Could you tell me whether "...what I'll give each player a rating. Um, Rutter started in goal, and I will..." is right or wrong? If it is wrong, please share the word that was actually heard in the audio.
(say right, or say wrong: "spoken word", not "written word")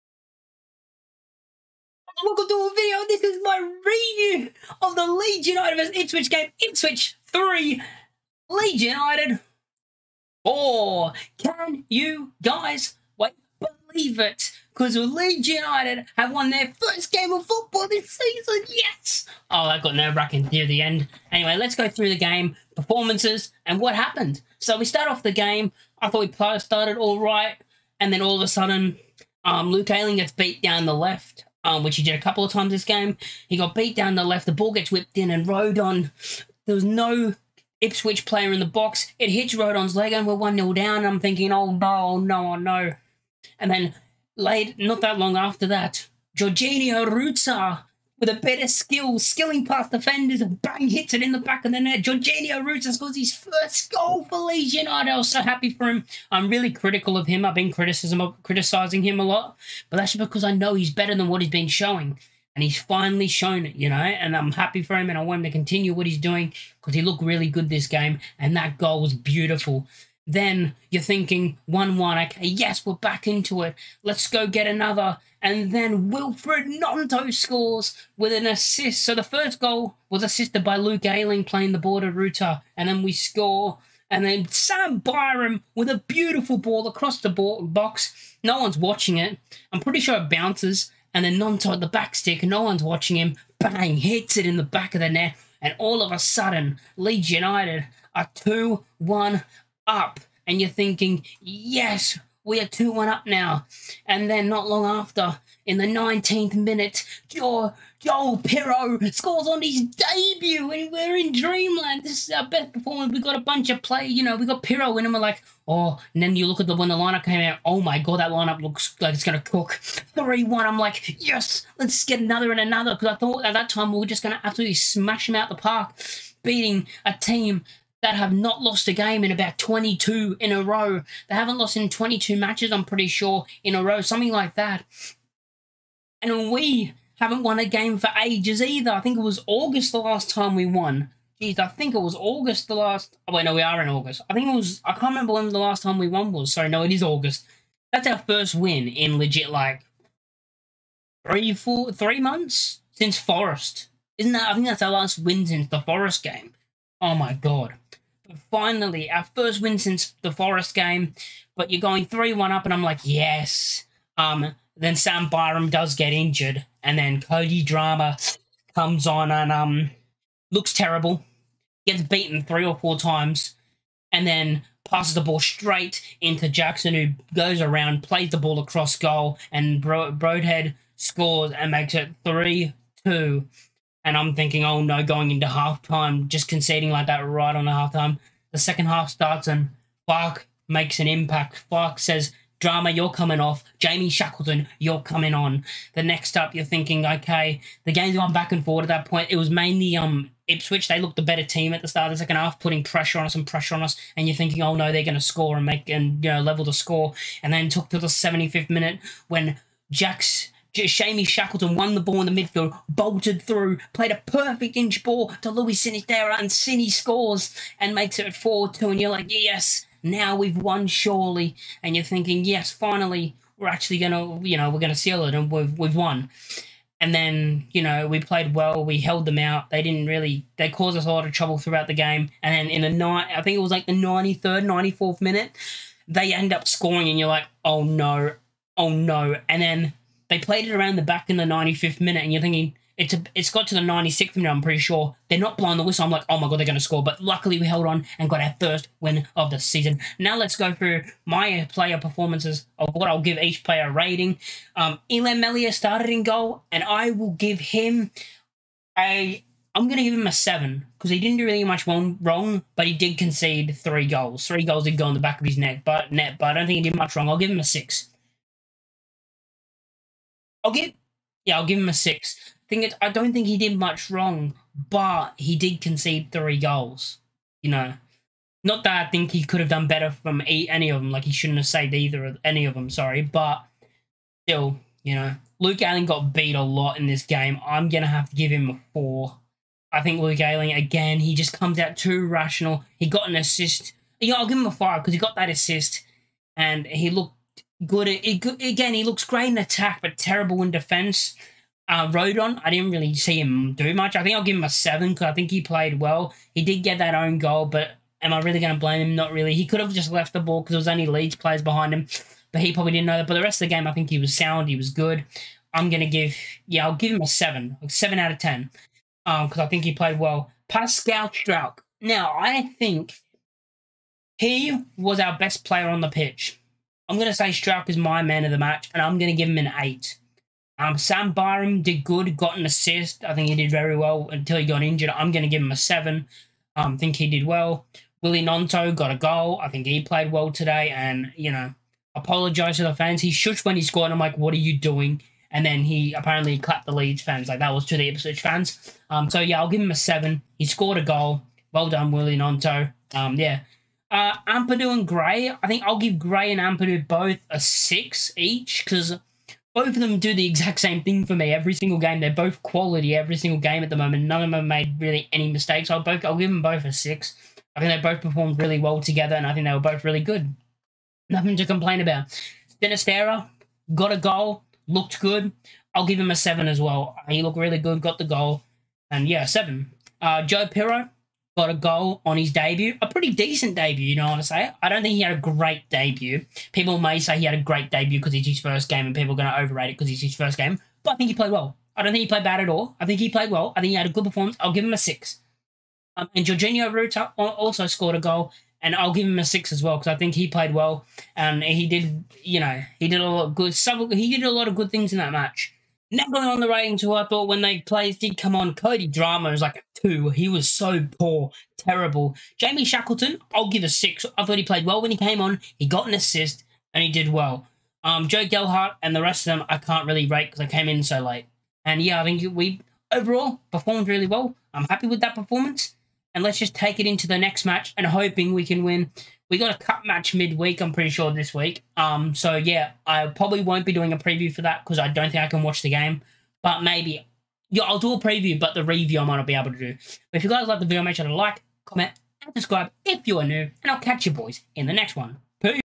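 wrong: "Meslier", not "Rutter".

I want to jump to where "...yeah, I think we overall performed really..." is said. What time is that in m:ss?
7:02.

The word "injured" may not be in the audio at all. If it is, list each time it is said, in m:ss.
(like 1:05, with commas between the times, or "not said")
2:46, 5:34.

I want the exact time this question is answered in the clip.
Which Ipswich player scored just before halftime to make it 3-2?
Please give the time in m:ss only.
3:00.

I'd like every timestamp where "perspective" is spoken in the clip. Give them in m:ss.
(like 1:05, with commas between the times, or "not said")
not said.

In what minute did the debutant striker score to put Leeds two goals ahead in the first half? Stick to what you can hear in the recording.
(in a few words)
19th.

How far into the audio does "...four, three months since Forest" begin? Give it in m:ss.
2:31.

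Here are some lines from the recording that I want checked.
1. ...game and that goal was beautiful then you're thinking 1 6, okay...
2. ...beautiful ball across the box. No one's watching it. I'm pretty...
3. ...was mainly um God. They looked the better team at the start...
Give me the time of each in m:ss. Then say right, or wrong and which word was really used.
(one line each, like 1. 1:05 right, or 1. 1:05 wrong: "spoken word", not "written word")
1. 1:07 wrong: "1", not "6"
2. 1:26 right
3. 3:19 wrong: "Ipswich", not "God".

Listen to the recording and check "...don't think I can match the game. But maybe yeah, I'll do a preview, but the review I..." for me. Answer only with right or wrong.
wrong.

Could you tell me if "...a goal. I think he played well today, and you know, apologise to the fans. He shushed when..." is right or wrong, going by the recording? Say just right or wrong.
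right.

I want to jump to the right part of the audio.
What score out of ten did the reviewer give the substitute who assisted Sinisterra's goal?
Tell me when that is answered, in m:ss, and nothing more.
6:53.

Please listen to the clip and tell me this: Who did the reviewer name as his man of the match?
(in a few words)
Pascal Struijk.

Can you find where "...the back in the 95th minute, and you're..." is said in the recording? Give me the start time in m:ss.
4:00.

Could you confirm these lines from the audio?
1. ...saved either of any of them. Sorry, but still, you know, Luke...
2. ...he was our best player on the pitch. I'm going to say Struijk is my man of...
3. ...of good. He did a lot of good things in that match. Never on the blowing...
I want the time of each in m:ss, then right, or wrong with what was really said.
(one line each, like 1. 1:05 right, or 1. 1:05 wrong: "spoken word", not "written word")
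1. 4:41 right
2. 5:24 right
3. 6:43 wrong: "rating", not "blowing".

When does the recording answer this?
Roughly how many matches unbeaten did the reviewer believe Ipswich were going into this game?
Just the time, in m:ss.
2:11.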